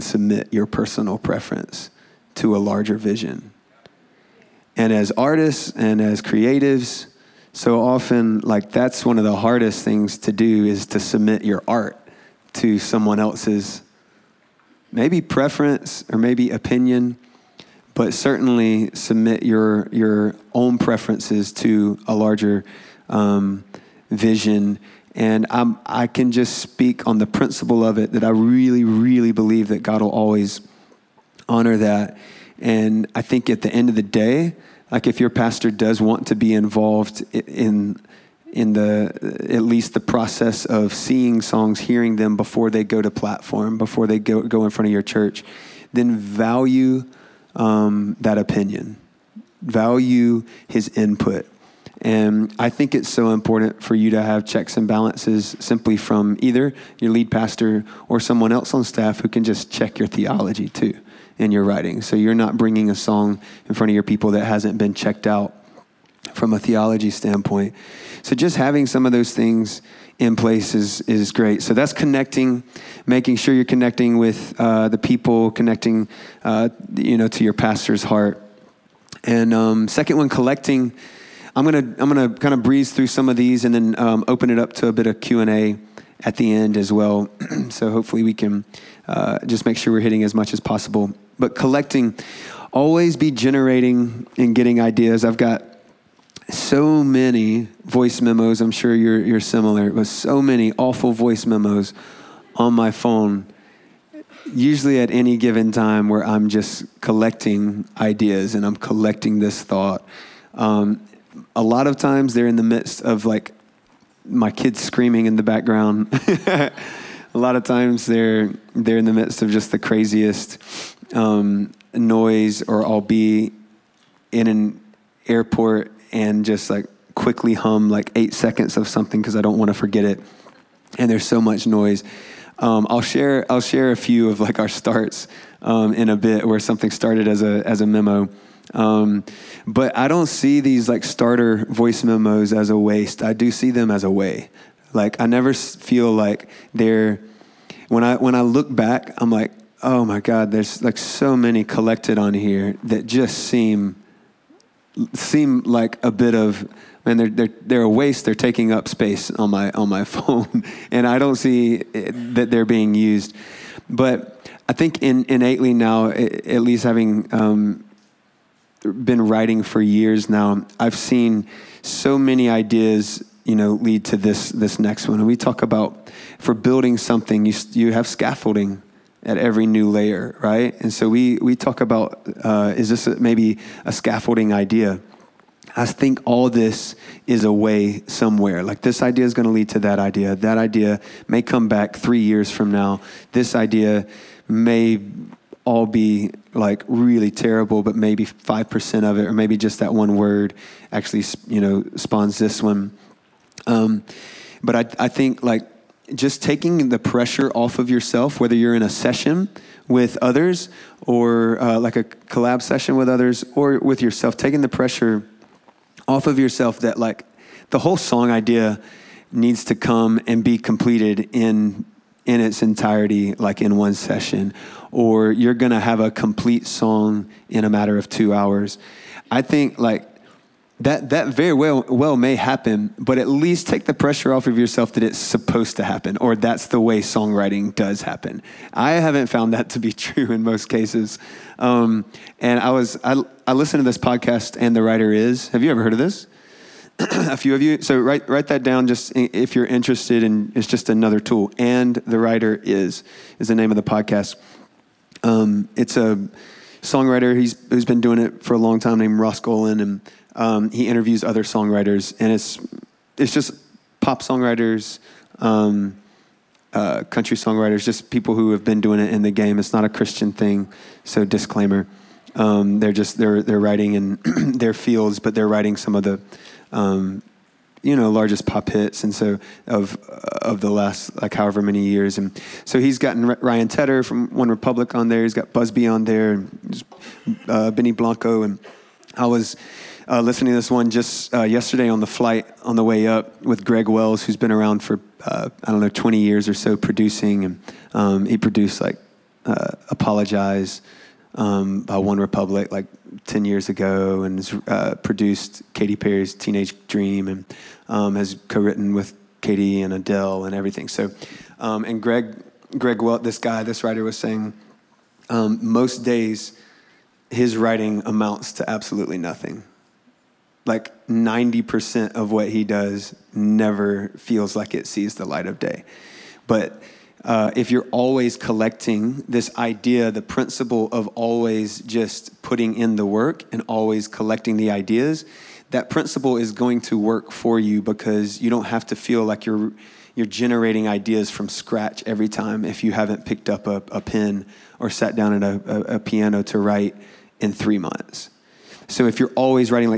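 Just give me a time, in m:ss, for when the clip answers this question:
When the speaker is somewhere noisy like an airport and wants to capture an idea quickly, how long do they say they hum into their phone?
2:08.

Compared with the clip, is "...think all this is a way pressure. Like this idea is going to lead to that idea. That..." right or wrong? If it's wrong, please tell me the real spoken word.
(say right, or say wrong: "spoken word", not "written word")
wrong: "somewhere", not "pressure".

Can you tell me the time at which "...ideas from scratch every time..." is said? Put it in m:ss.
5:40.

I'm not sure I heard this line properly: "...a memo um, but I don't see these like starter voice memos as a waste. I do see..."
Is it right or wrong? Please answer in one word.
right.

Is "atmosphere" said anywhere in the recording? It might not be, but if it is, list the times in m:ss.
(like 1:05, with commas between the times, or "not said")
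not said.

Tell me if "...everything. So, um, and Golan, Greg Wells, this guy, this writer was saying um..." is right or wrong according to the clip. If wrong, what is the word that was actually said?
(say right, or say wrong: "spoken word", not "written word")
wrong: "Greg", not "Golan".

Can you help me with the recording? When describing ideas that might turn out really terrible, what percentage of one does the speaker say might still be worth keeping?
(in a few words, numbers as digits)
5%.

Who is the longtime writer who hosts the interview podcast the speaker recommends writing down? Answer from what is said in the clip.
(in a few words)
Ross Golan.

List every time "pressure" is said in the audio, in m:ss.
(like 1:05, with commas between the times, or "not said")
3:26, 3:34, 3:53.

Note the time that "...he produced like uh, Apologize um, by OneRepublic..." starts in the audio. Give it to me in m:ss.
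4:58.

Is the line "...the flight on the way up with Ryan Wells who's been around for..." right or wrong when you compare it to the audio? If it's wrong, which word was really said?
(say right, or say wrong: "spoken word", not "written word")
wrong: "Greg", not "Ryan".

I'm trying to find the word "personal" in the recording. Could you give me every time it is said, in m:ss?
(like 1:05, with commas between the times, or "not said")
0:00.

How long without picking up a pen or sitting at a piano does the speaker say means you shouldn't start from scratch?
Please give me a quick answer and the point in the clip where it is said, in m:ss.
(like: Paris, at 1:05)
3 months, at 5:47.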